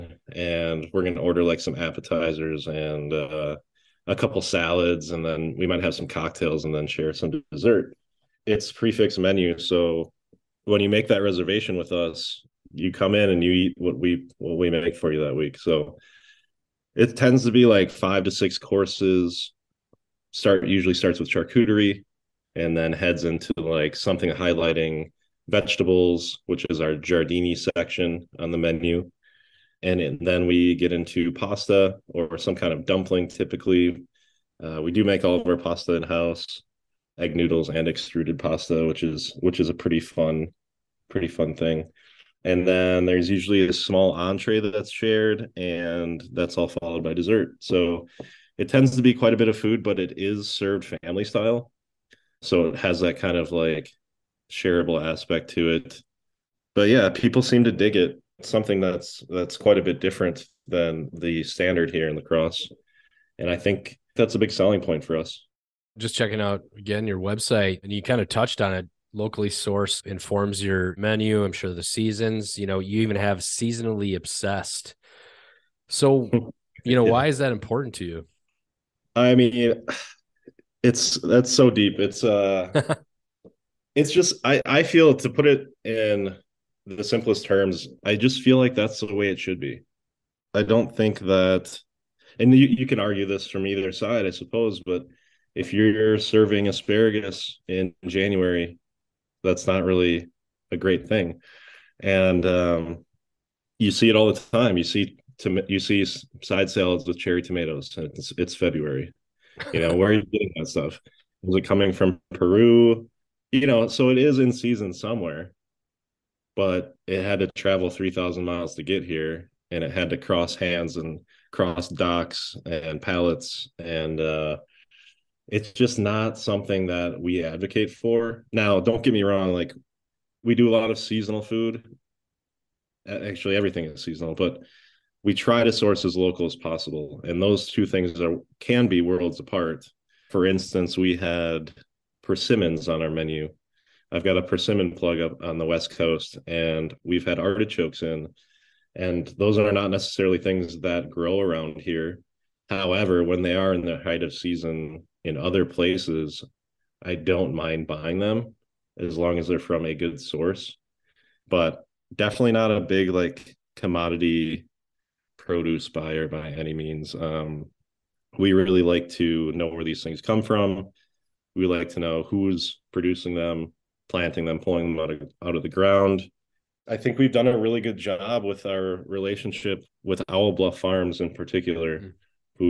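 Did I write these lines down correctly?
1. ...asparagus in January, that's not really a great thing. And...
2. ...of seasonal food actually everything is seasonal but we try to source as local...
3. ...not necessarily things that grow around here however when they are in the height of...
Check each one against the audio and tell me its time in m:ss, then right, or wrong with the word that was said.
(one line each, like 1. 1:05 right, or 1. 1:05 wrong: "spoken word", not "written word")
1. 1:36 right
2. 2:10 right
3. 2:29 right.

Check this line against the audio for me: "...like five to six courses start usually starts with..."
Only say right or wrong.
right.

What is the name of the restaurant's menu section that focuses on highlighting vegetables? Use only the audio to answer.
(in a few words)
giardini.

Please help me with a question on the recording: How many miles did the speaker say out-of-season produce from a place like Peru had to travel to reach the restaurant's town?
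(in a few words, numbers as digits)
3,000.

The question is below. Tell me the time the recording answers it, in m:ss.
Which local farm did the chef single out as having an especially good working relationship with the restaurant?
3:00.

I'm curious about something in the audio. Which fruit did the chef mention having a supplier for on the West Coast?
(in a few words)
persimmons.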